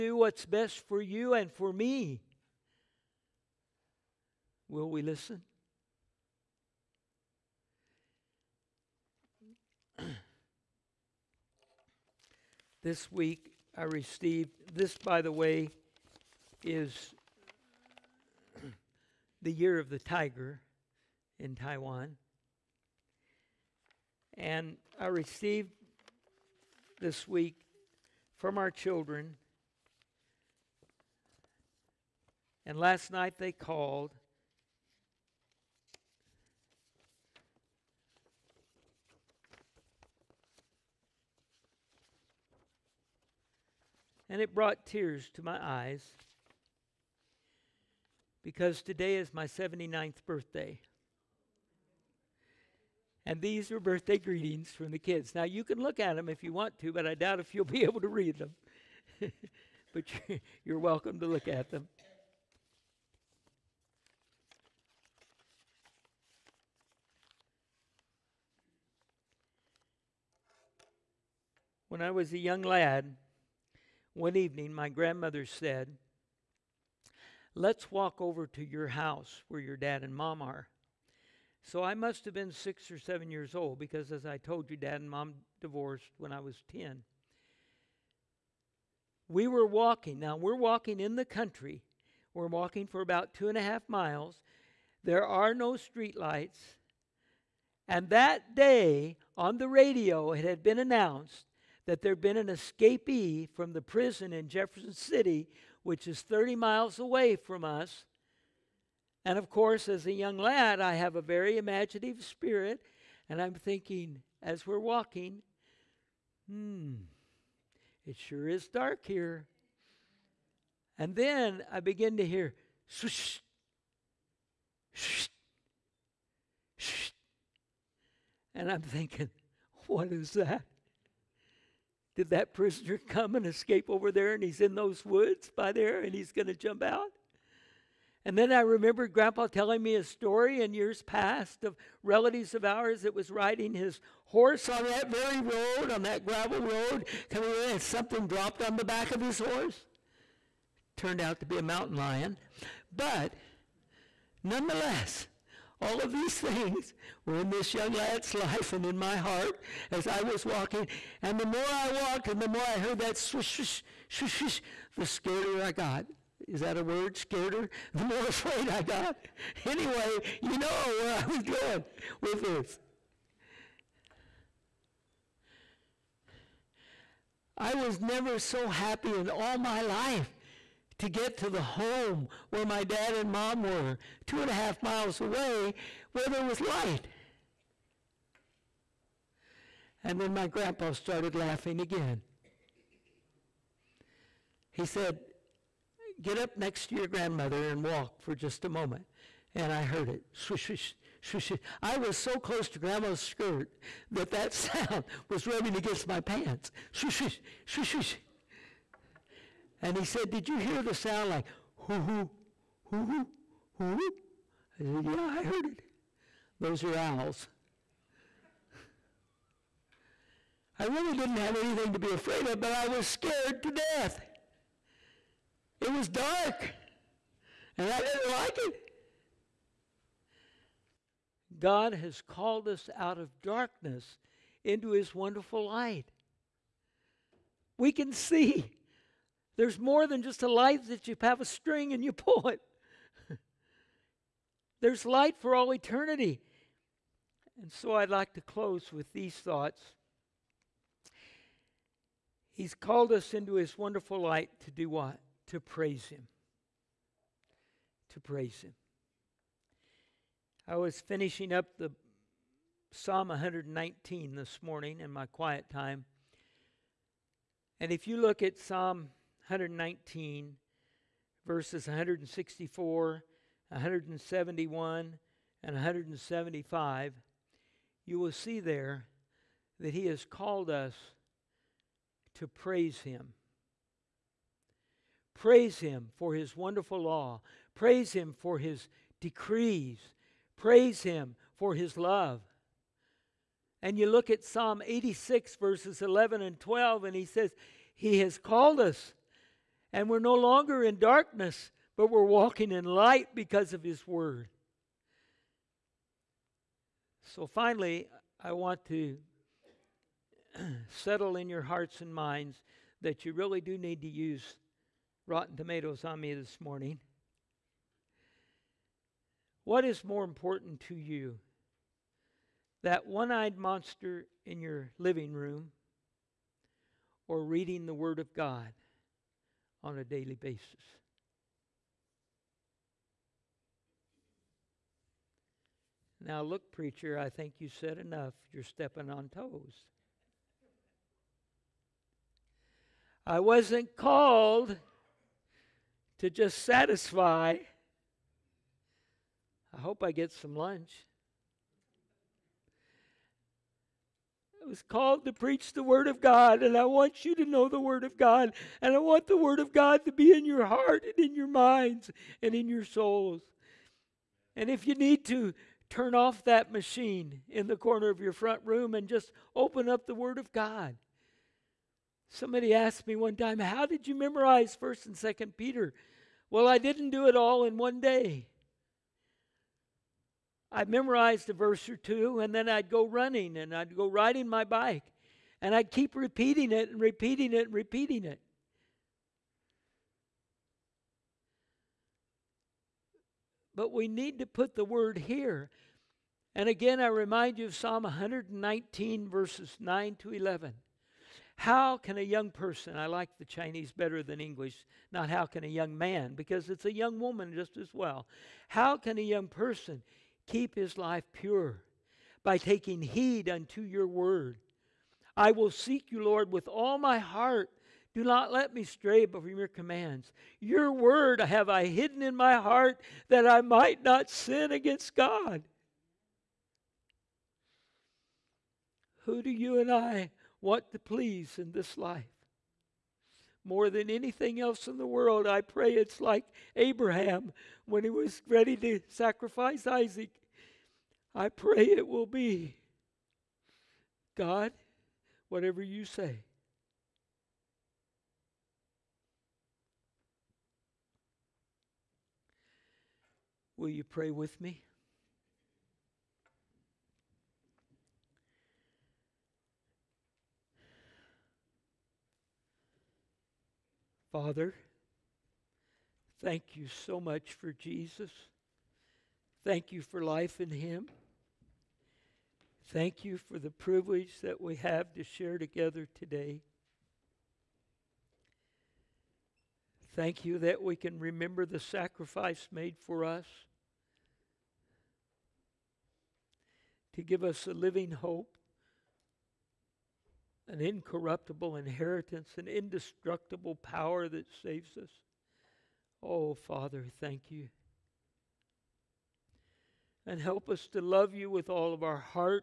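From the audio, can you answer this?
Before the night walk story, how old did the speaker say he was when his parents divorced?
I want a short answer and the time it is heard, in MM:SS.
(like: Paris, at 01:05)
10, at 01:26.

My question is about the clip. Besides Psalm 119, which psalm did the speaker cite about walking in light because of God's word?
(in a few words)
Psalm 86.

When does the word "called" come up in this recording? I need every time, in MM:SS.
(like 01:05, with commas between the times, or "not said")
00:33, 03:52, 04:12, 04:40, 04:58, 05:43, 05:54.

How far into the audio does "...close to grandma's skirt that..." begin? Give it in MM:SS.
03:22.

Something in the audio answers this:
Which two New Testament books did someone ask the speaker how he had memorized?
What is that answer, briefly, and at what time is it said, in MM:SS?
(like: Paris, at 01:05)
1st and 2nd Peter, at 06:14.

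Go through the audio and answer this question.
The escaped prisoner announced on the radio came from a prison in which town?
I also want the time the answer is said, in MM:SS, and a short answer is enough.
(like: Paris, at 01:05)
Jefferson City, at 01:44.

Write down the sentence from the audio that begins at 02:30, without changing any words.
Turned out to be a mountain lion.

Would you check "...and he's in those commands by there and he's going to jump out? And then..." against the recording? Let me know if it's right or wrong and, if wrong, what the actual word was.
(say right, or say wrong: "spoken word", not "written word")
wrong: "woods", not "commands".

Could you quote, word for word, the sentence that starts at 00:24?
And I received this week from our children.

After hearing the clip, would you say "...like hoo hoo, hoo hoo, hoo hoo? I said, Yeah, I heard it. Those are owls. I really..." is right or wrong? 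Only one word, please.
right.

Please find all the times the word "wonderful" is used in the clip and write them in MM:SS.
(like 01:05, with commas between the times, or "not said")
03:55, 04:13, 04:46.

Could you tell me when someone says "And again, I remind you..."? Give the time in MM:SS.
06:36.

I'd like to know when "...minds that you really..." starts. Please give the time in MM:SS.
05:12.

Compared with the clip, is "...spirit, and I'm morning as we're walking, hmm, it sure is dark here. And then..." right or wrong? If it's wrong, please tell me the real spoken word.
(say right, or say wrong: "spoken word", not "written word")
wrong: "thinking", not "morning".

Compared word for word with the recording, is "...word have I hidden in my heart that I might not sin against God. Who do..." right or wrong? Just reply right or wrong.
right.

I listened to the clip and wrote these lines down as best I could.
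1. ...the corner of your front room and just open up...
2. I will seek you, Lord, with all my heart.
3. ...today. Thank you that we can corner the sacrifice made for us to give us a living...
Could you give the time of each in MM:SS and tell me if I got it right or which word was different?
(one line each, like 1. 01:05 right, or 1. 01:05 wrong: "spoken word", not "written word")
1. 06:07 right
2. 06:55 right
3. 07:56 wrong: "remember", not "corner".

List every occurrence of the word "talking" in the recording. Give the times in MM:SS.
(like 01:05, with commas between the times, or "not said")
not said.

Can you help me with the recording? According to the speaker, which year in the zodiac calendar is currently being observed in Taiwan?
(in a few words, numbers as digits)
Year of the tiger.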